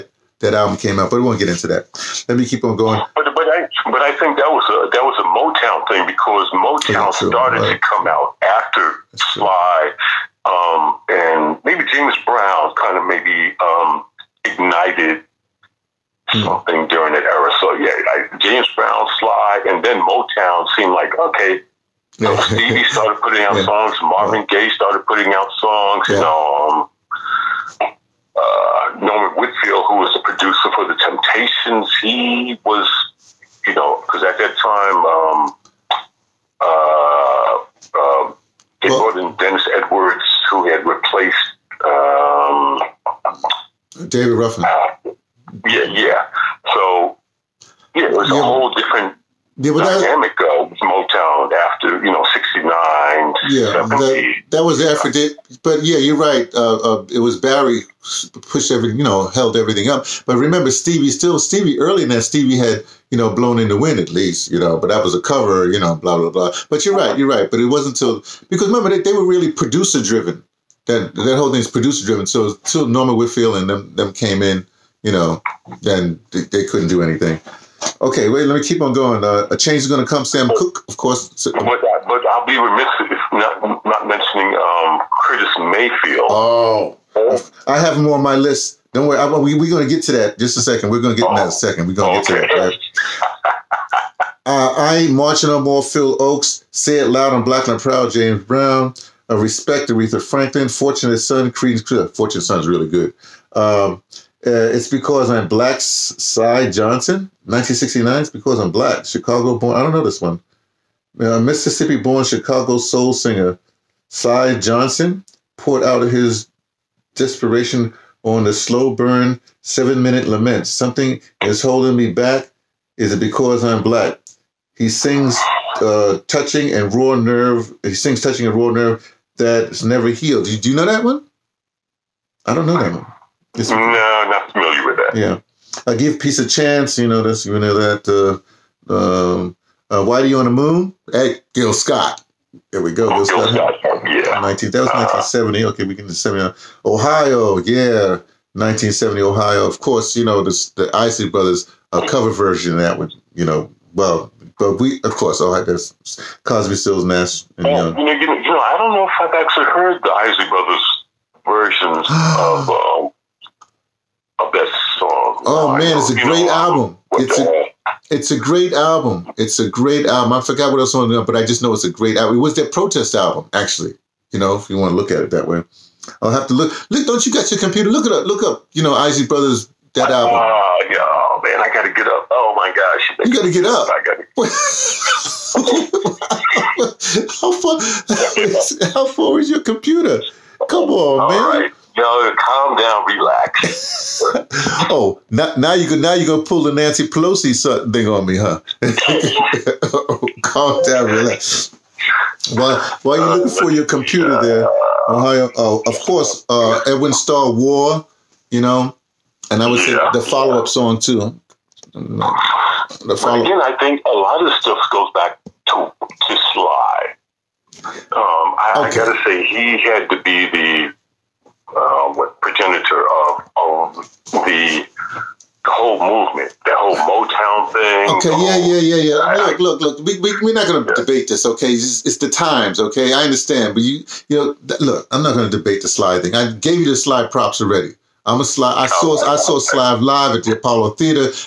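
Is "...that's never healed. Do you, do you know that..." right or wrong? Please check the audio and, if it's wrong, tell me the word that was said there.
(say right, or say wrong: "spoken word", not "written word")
right.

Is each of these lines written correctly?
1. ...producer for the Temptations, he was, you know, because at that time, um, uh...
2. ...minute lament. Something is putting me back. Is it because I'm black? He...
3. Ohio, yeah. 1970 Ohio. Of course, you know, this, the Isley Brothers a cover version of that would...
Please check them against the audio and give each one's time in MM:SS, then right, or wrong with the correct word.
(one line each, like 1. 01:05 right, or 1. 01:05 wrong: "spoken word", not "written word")
1. 00:30 right
2. 02:00 wrong: "holding", not "putting"
3. 02:26 right.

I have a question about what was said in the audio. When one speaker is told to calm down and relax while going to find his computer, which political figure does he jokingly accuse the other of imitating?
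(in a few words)
Nancy Pelosi.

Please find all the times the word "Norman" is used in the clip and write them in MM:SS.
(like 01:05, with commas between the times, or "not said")
00:29, 01:12.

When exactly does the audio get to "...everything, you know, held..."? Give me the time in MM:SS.
00:58.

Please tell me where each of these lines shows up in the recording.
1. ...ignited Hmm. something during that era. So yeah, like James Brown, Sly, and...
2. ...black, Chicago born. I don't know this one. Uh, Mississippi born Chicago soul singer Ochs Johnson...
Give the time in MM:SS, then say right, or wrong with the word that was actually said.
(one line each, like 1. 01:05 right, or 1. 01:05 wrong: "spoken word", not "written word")
1. 00:14 right
2. 01:48 wrong: "Syl", not "Ochs".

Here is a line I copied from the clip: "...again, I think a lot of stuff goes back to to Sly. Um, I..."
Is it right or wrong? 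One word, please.
right.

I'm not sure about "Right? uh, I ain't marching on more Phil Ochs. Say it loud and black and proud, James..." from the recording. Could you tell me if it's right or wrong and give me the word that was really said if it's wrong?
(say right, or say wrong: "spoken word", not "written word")
right.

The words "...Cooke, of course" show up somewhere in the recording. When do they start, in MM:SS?
01:20.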